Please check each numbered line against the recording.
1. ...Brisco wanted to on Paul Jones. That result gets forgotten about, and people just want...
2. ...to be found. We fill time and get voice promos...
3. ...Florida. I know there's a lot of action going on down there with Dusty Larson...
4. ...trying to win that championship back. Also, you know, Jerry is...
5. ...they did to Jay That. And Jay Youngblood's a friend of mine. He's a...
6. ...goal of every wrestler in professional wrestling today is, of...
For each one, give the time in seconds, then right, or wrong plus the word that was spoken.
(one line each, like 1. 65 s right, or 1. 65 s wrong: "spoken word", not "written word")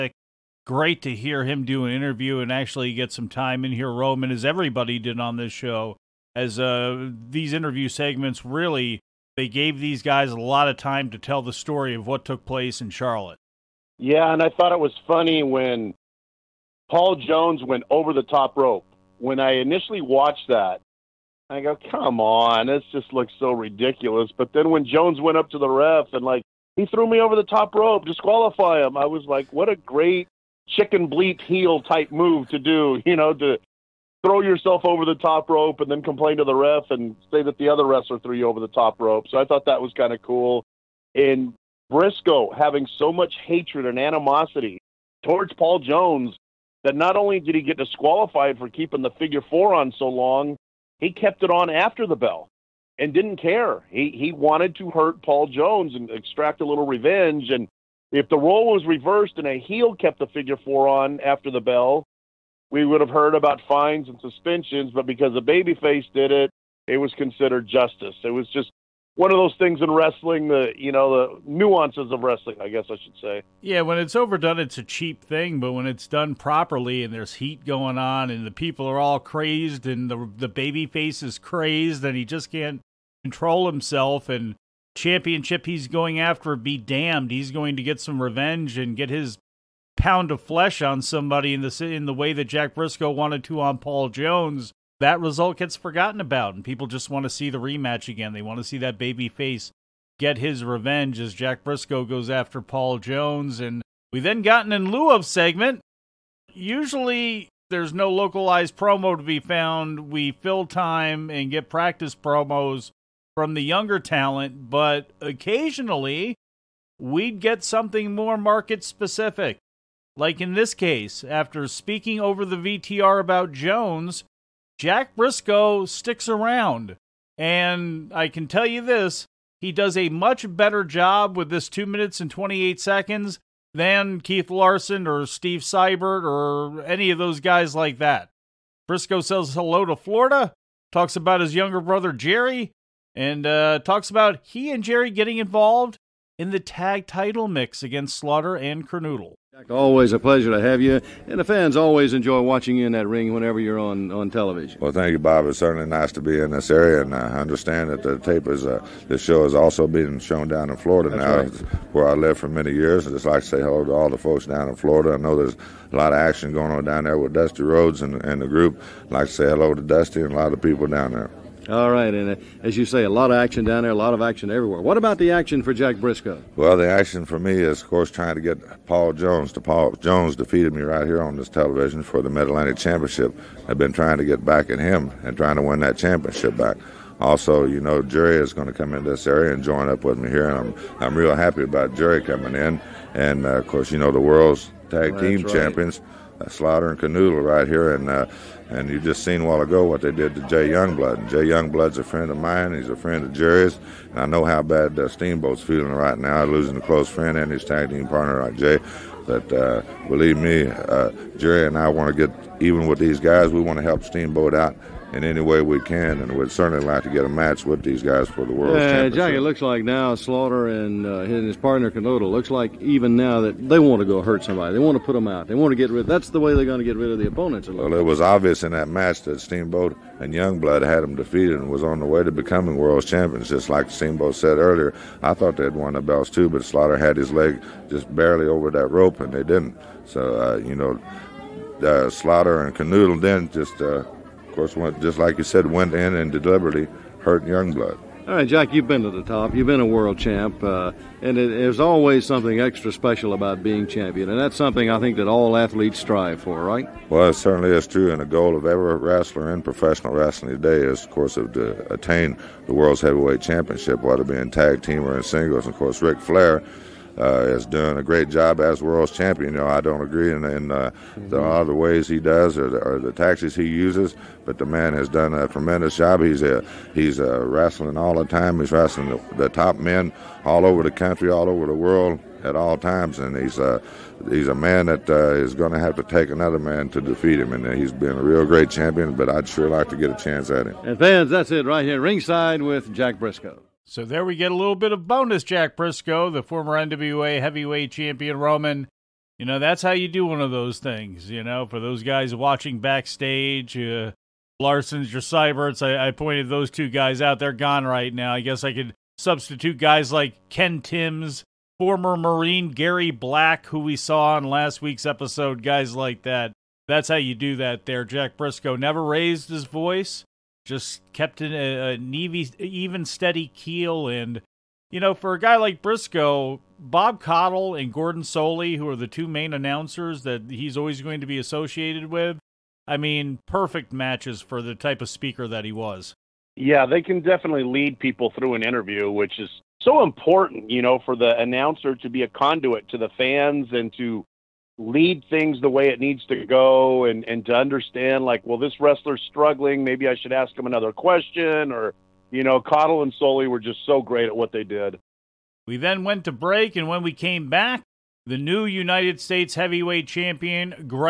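1. 92 s right
2. 109 s wrong: "practice", not "voice"
3. 164 s wrong: "Rhodes", not "Larson"
4. 185 s right
5. 200 s wrong: "Youngblood", not "That"
6. 258 s right.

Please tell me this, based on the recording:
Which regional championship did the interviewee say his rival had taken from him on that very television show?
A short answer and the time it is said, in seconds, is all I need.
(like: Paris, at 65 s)
Mid Atlantic Championship, at 182 s.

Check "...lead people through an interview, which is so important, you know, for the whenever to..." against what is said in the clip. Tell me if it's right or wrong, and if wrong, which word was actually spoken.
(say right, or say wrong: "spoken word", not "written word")
wrong: "announcer", not "whenever".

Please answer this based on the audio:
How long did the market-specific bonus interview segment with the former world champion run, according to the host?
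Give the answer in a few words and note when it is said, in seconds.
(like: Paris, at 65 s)
2 minutes and 28 seconds, at 131 s.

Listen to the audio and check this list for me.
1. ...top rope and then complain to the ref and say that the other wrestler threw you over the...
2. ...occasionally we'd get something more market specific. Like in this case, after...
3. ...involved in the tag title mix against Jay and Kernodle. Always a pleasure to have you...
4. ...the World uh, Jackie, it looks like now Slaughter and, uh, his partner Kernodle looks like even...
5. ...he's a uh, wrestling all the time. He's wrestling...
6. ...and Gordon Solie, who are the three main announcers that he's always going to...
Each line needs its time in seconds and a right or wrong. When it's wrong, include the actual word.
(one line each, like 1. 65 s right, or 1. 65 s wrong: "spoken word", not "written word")
1. 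35 s right
2. 115 s right
3. 145 s wrong: "Slaughter", not "Jay"
4. 218 s right
5. 276 s right
6. 327 s wrong: "two", not "three".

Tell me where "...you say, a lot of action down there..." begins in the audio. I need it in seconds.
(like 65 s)
172 s.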